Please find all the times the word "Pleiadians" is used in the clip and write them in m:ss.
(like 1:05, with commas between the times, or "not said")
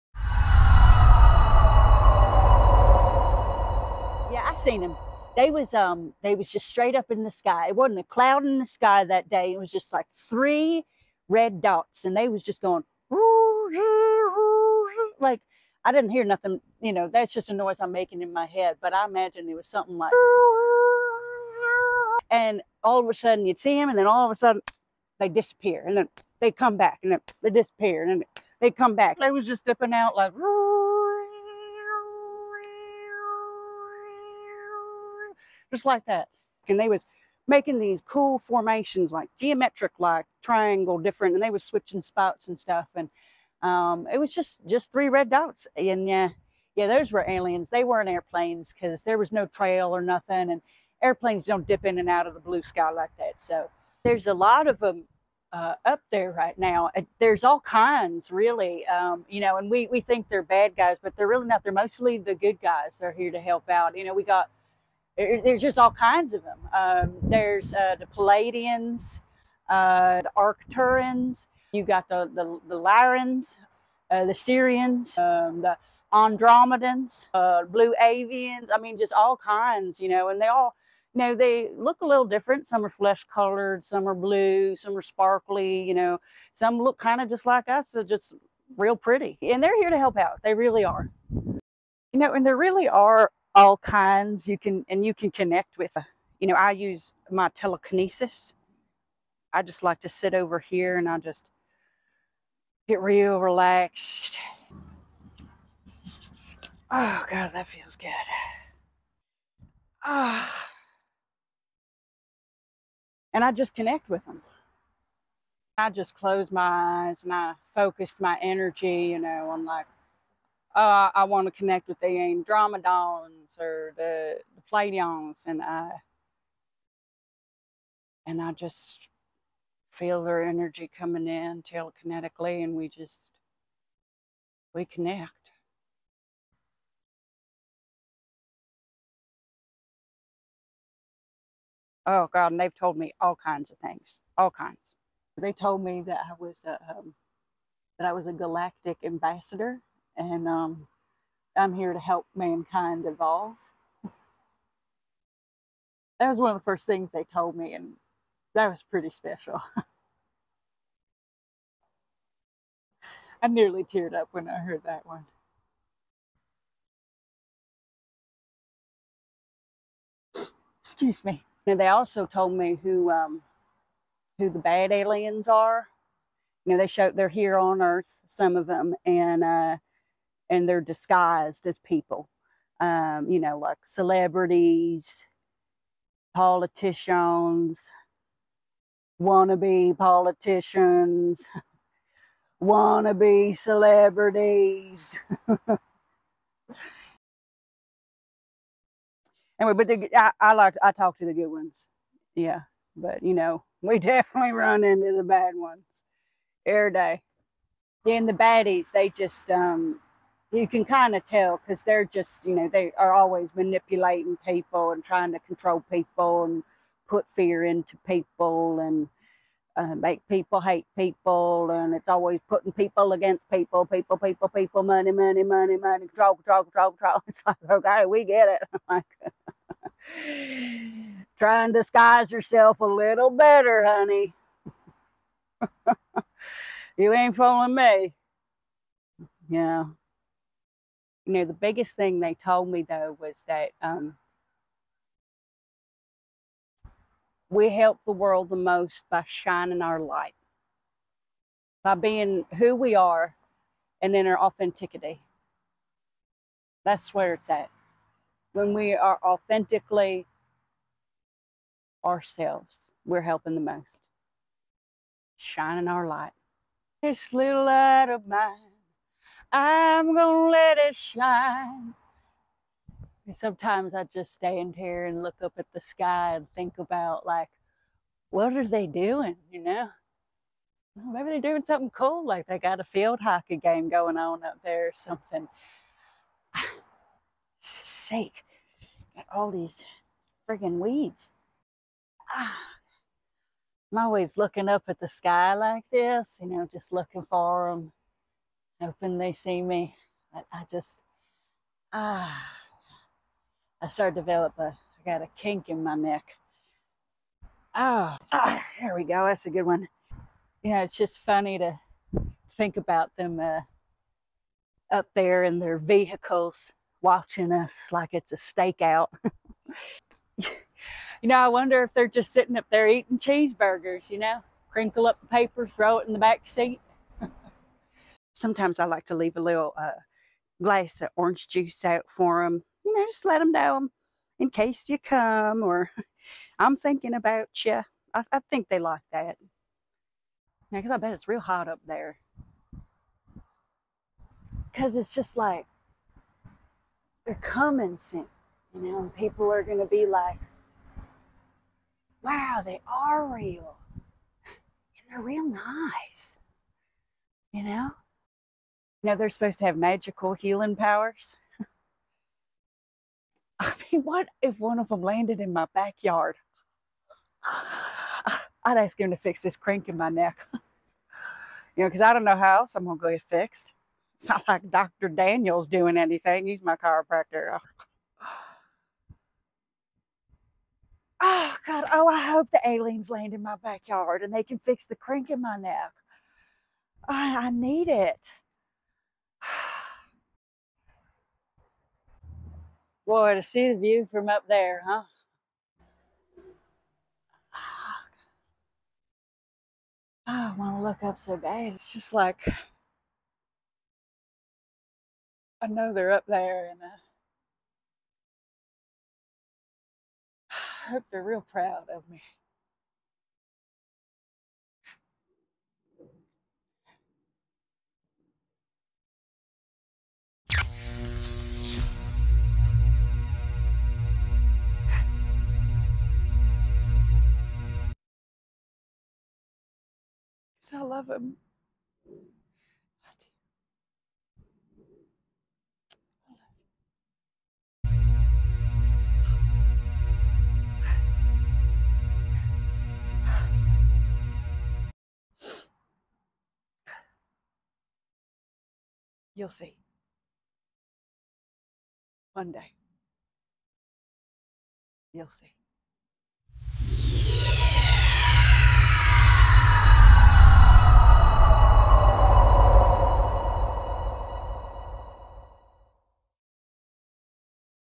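1:08, 2:04.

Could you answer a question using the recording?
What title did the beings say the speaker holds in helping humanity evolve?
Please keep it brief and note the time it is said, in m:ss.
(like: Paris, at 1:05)
Galactic ambassador, at 2:28.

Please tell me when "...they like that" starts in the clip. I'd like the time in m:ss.
5:38.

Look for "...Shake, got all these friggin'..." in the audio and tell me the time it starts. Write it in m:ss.
4:47.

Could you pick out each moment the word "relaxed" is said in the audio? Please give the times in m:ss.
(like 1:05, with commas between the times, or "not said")
1:43.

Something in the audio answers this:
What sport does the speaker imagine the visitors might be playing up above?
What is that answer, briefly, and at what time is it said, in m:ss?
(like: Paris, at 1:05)
Field hockey, at 4:42.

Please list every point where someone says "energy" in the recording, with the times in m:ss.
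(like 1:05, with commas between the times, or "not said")
1:58, 2:10.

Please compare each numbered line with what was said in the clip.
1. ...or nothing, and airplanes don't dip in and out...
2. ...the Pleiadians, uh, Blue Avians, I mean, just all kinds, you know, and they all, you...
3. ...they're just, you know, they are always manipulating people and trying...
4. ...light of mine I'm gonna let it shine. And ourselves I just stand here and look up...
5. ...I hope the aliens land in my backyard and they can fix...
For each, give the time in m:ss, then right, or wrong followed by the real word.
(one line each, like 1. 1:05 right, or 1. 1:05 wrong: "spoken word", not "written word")
1. 0:49 right
2. 1:15 wrong: "Andromedans", not "Pleiadians"
3. 3:31 right
4. 4:27 wrong: "sometimes", not "ourselves"
5. 6:22 right.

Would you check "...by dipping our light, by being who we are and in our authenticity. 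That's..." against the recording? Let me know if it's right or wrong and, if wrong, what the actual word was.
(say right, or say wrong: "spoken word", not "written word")
wrong: "shining", not "dipping".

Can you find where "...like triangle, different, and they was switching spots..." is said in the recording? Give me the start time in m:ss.
0:39.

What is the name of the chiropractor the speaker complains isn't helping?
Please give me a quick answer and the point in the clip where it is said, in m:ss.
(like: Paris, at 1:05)
Dr. Daniel, at 6:14.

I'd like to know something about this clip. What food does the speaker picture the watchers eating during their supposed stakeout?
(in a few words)
Cheeseburgers.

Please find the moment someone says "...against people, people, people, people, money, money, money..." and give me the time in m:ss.
3:43.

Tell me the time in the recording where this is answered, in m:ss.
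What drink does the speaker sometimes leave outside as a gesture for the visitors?
5:31.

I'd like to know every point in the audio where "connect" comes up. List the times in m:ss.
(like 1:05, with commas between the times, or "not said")
1:35, 1:53, 2:01, 2:14.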